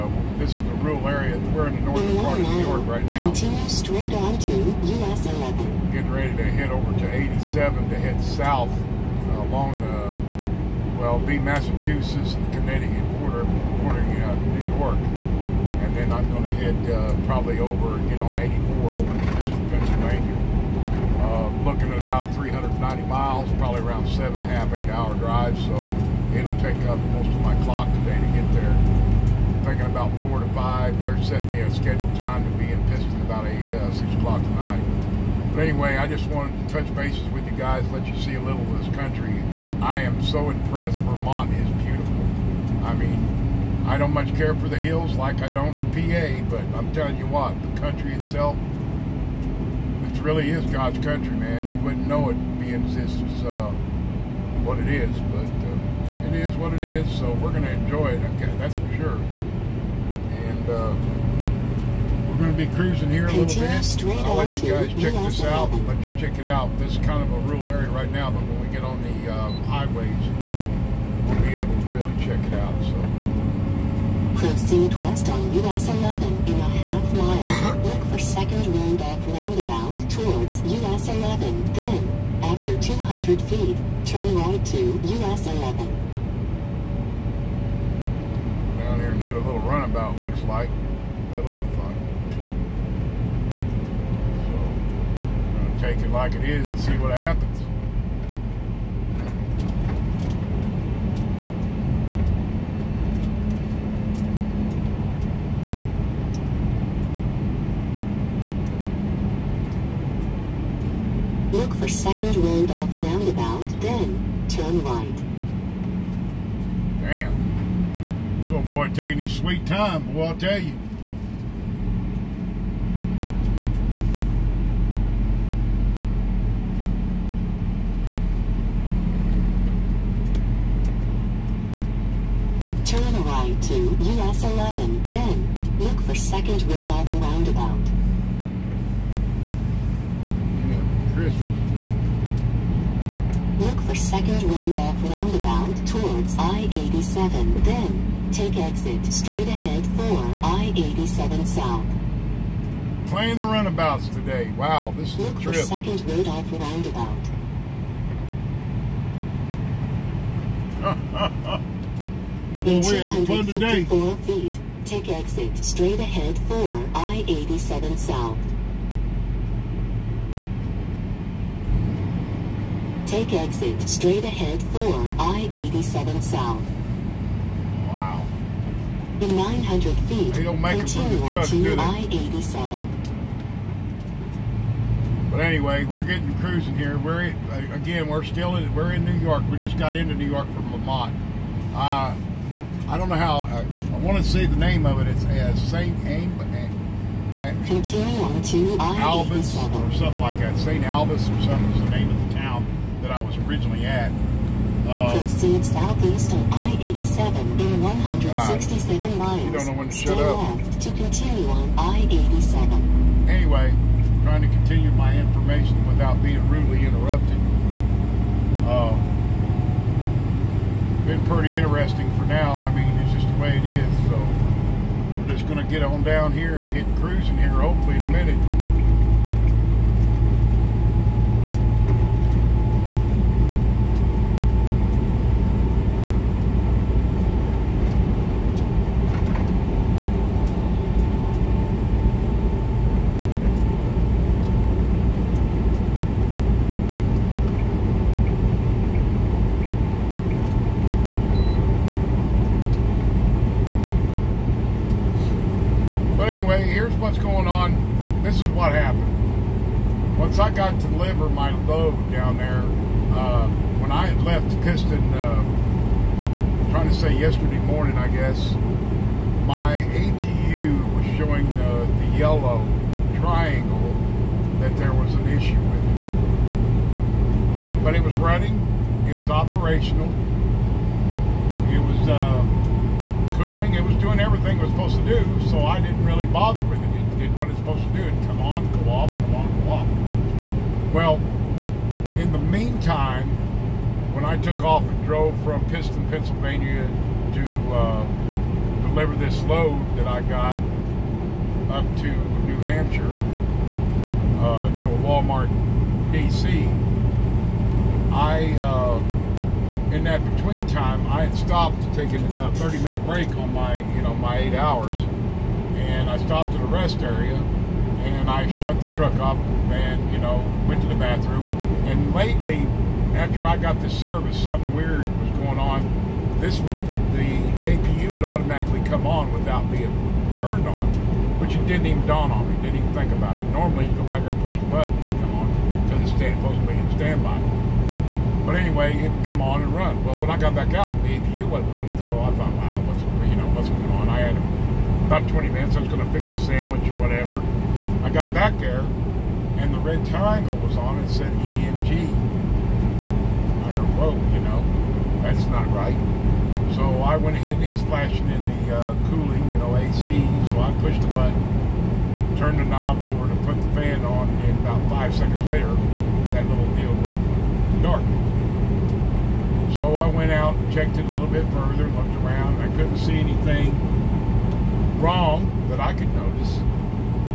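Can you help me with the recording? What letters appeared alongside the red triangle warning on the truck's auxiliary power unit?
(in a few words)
EMG.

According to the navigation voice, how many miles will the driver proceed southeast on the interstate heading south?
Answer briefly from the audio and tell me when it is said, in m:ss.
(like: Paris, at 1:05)
167 miles, at 3:27.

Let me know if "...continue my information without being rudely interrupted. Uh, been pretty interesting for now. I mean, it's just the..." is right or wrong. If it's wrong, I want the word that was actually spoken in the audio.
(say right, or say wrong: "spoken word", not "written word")
right.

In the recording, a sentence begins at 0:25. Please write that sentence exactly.
So it'll take up most of my clock today to get there.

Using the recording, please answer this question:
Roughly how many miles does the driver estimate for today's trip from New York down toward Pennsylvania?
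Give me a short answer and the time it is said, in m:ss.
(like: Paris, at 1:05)
390 miles, at 0:22.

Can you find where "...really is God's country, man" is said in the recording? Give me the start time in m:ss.
0:50.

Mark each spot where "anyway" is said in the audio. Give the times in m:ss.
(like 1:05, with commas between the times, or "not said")
0:35, 3:05, 3:33, 5:38.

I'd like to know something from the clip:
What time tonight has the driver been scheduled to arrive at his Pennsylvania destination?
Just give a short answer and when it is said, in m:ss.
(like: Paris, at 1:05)
6 o'clock, at 0:33.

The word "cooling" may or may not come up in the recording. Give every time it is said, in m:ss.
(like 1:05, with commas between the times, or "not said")
4:43, 5:59.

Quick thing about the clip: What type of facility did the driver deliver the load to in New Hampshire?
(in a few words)
Walmart DC.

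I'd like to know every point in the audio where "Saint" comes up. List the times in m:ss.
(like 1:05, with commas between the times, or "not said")
3:15, 3:20.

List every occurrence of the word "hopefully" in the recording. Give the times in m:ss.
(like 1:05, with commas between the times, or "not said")
3:47.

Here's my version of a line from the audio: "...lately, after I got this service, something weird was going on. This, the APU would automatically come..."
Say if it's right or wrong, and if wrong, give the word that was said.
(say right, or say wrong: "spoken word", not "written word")
right.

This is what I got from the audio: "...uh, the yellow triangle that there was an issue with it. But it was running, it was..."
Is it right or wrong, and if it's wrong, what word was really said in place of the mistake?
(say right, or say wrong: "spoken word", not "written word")
right.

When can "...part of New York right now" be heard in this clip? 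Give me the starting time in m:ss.
0:02.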